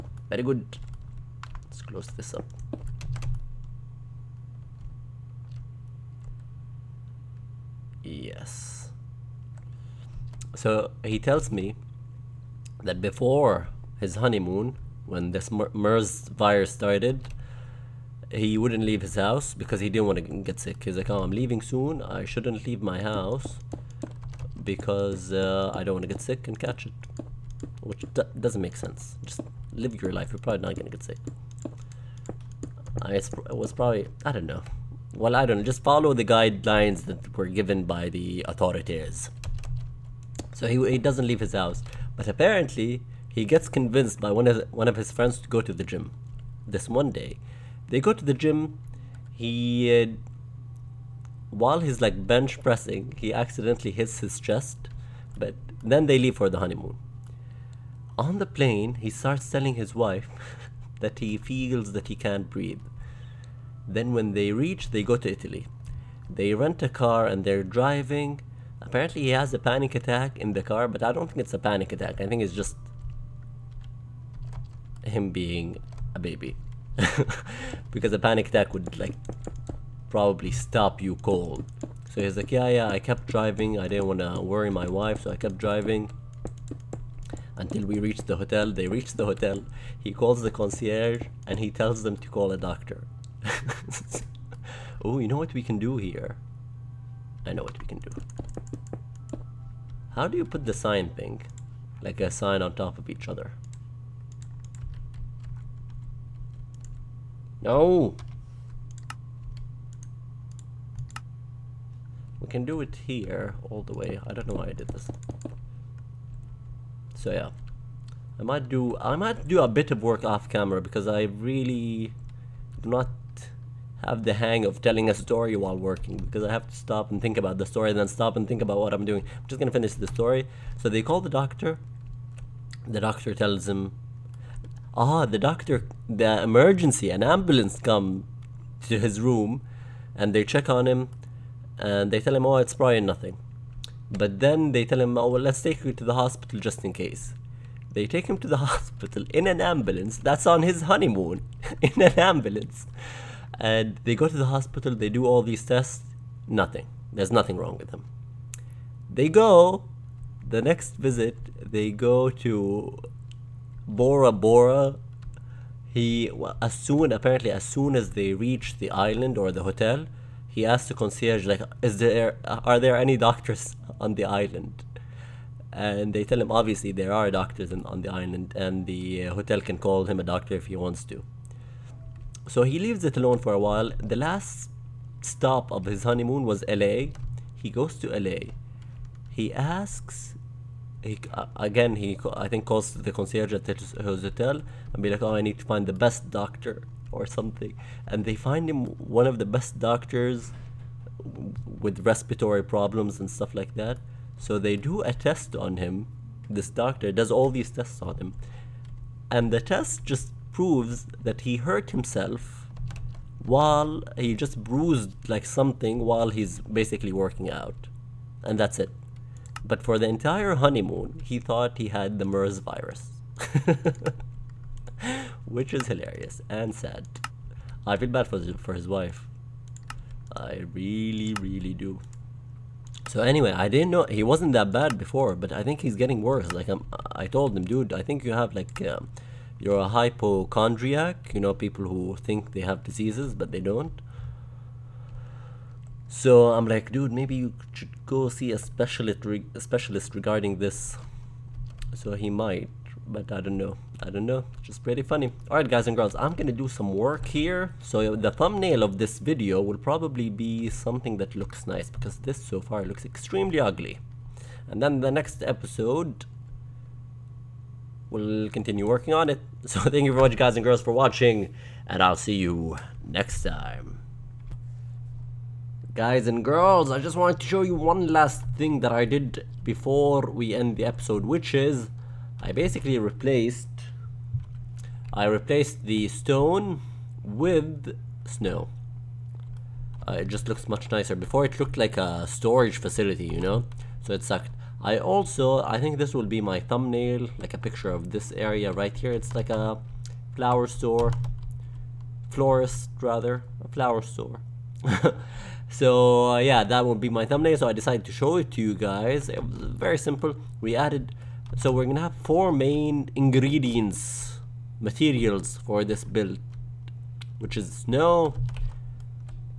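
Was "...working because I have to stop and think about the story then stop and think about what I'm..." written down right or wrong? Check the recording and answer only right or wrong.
right.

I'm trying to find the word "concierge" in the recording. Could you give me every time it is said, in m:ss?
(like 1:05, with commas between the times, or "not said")
1:30, 2:50, 3:13.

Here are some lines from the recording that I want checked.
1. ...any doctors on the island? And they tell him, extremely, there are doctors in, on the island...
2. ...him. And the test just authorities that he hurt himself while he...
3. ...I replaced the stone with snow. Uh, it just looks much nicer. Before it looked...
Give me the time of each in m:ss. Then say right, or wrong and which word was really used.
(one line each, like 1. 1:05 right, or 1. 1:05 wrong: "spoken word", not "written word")
1. 2:52 wrong: "obviously", not "extremely"
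2. 3:28 wrong: "proves", not "authorities"
3. 4:45 right.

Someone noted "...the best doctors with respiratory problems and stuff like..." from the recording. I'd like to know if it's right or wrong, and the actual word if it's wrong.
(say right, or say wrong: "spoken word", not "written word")
right.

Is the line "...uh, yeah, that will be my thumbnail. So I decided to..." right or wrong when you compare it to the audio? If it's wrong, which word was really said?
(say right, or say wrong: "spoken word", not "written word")
right.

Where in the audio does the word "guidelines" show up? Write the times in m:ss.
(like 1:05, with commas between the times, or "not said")
0:36.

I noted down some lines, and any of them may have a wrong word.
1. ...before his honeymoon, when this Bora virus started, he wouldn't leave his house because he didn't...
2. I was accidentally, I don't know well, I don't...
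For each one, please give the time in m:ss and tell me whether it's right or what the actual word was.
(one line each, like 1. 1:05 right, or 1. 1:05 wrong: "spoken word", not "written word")
1. 0:12 wrong: "MERS", not "Bora"
2. 0:33 wrong: "probably", not "accidentally".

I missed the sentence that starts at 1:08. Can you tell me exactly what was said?
Apparently, he has a panic attack in the car, but I don't think it's a panic attack.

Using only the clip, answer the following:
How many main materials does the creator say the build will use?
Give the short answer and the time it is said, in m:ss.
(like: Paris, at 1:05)
4, at 5:12.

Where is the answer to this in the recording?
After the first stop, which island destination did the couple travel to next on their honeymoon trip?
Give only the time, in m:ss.
2:43.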